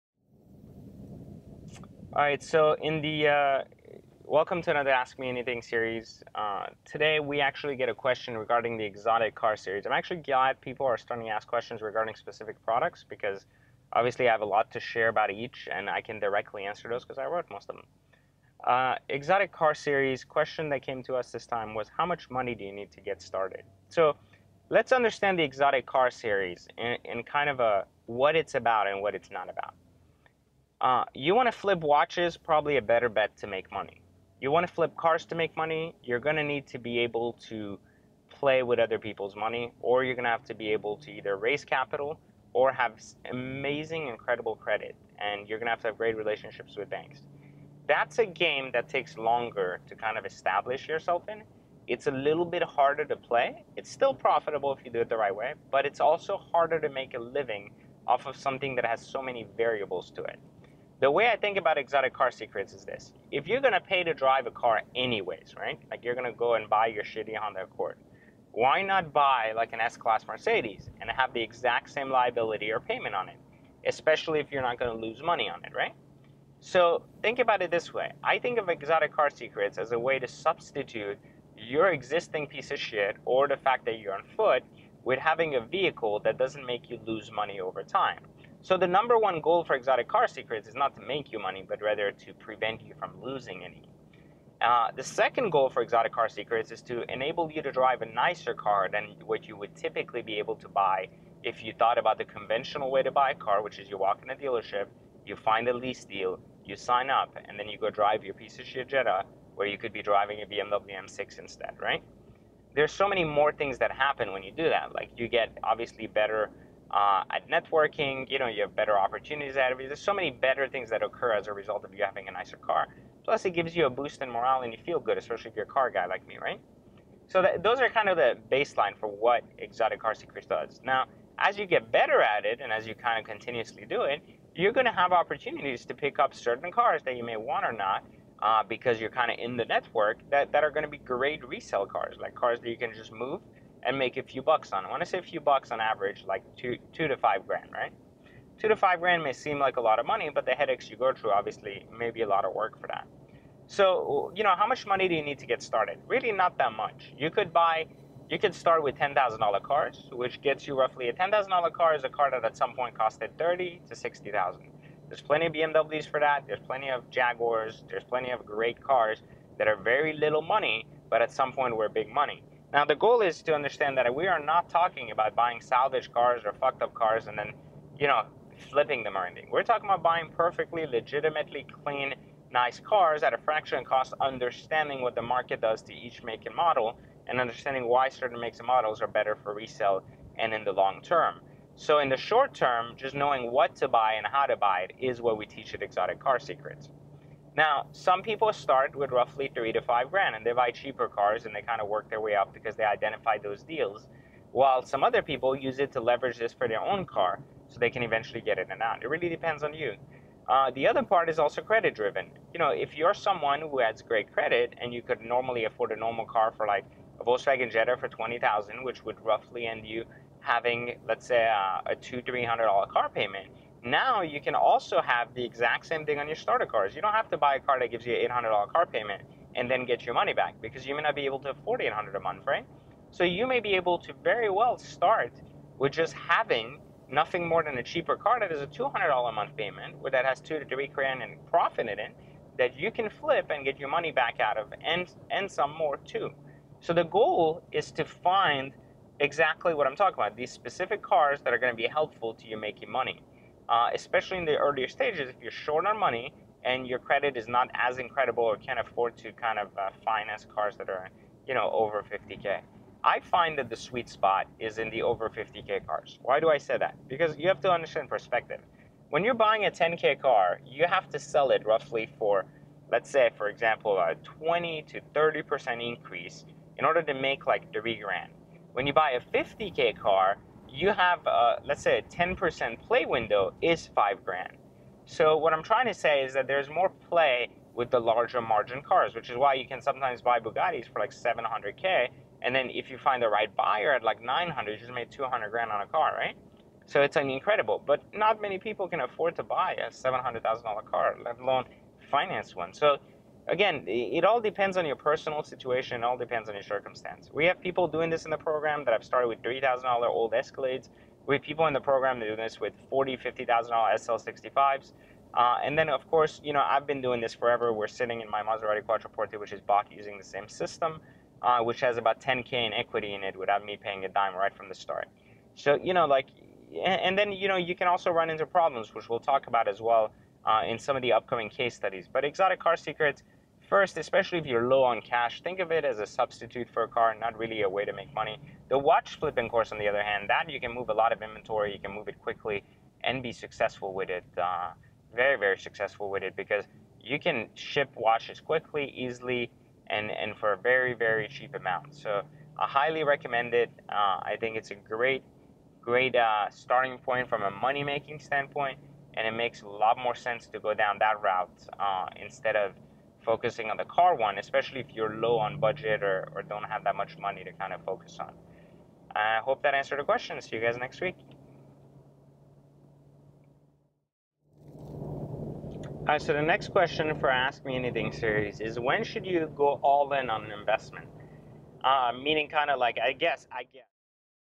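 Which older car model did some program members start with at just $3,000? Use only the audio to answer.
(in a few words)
Escalades.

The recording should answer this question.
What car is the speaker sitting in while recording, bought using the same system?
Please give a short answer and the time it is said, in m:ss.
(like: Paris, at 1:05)
Maserati Quattroporte, at 5:18.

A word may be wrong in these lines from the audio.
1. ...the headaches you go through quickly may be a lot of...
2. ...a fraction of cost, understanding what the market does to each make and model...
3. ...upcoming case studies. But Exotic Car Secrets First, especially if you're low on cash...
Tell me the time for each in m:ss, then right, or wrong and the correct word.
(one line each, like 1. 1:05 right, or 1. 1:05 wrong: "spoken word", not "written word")
1. 2:30 wrong: "obviously", not "quickly"
2. 3:03 right
3. 5:31 right.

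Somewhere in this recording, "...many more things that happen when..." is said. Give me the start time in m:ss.
1:53.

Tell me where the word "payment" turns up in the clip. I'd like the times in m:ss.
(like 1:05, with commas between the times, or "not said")
1:12, 3:43, 3:48, 3:59.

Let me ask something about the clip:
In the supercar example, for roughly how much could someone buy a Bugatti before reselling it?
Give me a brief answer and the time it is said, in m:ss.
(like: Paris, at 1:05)
700k, at 4:51.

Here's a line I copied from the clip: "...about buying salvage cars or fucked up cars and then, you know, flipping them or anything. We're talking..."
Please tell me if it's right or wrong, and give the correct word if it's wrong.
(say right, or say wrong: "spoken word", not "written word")
right.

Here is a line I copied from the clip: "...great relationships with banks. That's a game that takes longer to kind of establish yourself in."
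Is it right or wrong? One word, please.
right.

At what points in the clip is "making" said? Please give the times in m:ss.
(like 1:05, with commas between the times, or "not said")
4:12, 5:57.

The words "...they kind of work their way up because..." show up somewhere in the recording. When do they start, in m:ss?
3:21.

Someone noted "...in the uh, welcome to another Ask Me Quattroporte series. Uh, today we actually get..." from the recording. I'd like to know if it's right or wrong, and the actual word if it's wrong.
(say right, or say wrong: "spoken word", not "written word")
wrong: "Anything", not "Quattroporte".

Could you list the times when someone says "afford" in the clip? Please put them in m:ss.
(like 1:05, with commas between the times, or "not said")
3:35, 3:51, 4:18, 4:59.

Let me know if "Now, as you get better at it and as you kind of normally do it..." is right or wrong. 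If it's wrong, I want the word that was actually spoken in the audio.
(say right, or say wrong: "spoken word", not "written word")
wrong: "continuously", not "normally".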